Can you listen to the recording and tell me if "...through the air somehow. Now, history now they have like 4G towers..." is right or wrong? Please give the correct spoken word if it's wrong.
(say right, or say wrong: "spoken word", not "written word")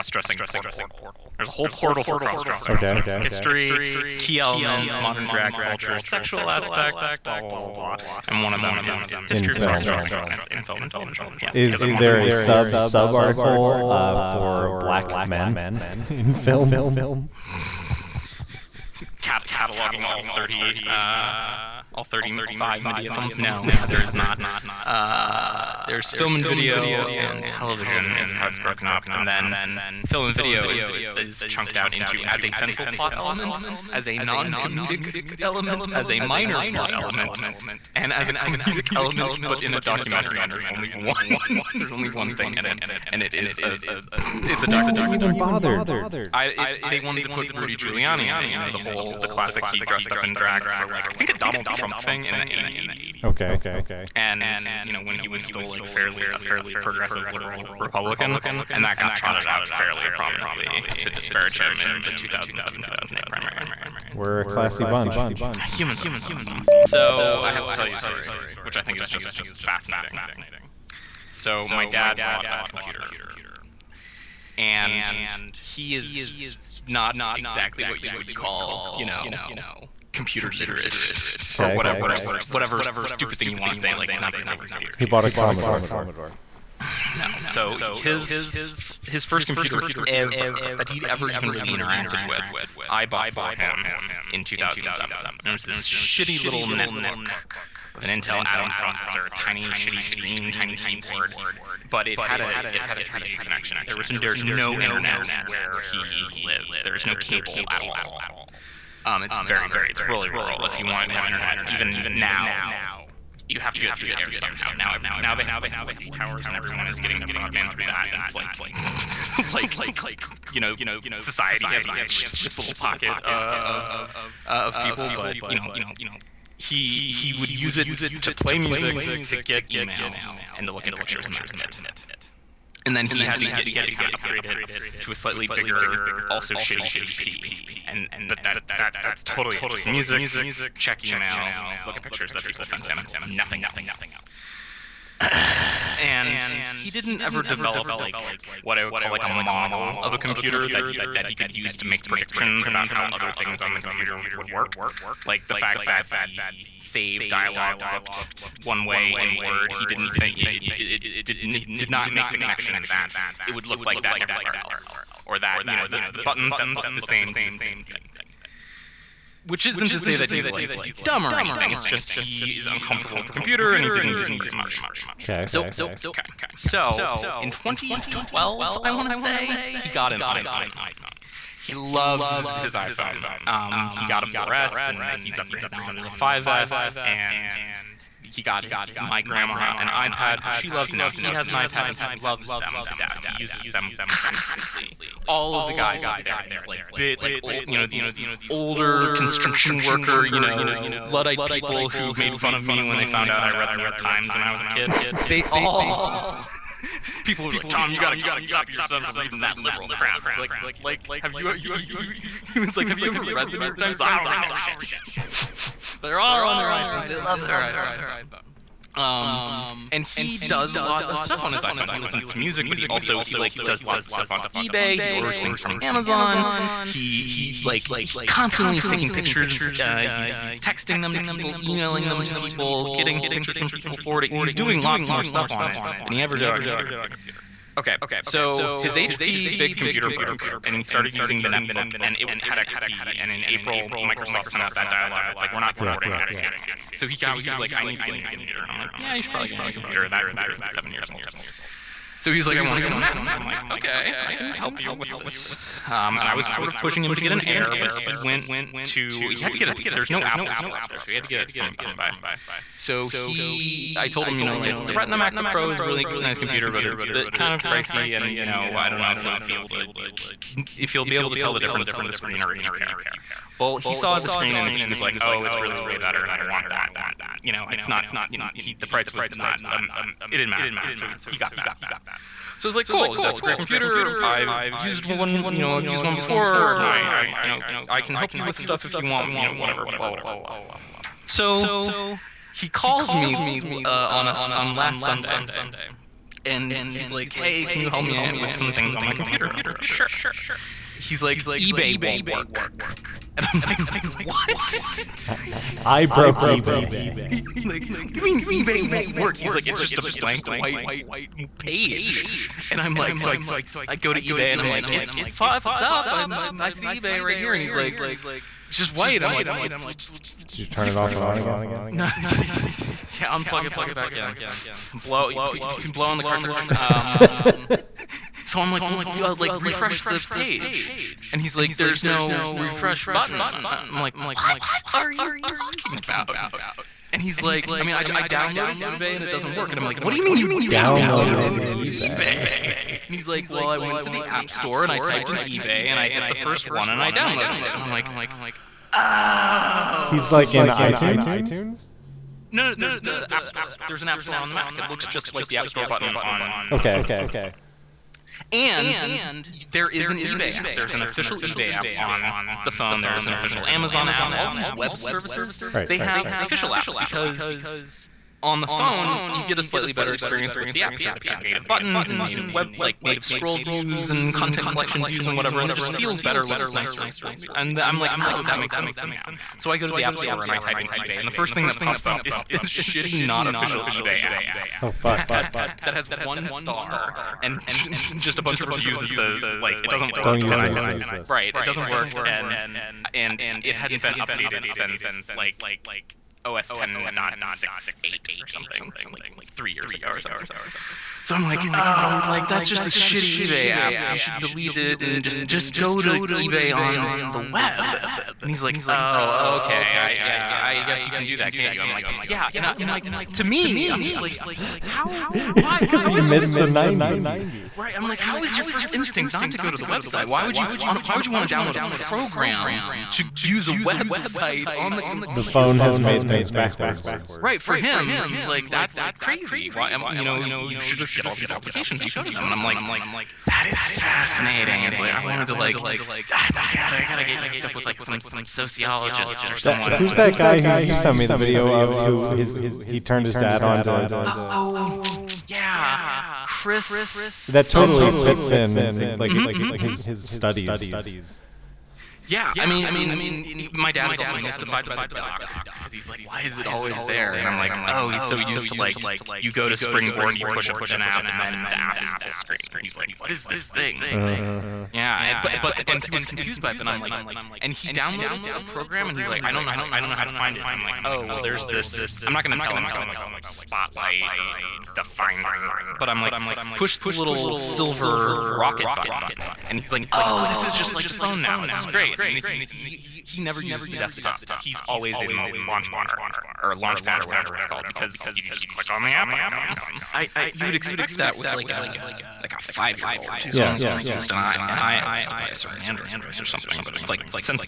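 wrong: "every", not "history".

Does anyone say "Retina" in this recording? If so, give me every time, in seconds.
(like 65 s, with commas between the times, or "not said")
264 s.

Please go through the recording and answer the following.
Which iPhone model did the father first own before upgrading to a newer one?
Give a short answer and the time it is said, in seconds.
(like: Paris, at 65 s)
4S, at 184 s.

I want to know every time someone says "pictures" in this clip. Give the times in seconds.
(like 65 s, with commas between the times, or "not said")
130 s, 142 s, 229 s, 233 s.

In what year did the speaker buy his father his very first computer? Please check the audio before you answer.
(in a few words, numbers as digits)
2007.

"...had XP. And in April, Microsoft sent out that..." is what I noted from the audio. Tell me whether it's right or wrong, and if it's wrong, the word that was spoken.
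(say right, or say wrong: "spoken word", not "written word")
right.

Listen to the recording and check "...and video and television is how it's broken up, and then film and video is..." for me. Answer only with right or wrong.
right.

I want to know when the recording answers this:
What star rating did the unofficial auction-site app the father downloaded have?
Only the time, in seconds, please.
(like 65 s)
386 s.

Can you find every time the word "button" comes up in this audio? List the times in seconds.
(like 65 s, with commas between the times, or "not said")
166 s, 333 s, 355 s, 371 s, 478 s.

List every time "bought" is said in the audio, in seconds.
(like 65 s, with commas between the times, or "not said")
72 s, 85 s, 93 s.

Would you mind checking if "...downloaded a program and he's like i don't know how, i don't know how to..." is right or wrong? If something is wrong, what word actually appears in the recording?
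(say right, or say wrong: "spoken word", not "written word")
right.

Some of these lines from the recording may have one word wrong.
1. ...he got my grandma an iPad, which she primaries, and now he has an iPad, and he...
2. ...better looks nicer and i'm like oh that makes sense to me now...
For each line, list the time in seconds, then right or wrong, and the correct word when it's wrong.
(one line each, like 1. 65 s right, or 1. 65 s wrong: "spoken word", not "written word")
1. 188 s wrong: "loves", not "primaries"
2. 376 s right.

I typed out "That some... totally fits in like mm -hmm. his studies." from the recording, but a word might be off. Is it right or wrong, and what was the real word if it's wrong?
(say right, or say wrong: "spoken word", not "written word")
right.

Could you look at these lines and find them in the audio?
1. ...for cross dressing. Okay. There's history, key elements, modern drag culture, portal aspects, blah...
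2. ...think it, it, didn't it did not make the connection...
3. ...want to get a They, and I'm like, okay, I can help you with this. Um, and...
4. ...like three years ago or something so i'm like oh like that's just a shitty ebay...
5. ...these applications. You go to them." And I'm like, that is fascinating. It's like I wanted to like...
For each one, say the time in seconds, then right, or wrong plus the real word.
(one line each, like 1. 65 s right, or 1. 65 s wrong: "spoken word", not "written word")
1. 2 s wrong: "sexual", not "portal"
2. 160 s right
3. 252 s wrong: "Mac", not "They"
4. 399 s right
5. 431 s right.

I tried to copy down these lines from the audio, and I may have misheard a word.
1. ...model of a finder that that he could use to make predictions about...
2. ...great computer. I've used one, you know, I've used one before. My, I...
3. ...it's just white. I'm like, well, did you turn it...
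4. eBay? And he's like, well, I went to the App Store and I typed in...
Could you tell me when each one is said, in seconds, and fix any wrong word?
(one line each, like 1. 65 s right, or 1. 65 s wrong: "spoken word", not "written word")
1. 149 s wrong: "computer", not "finder"
2. 283 s right
3. 318 s right
4. 342 s right.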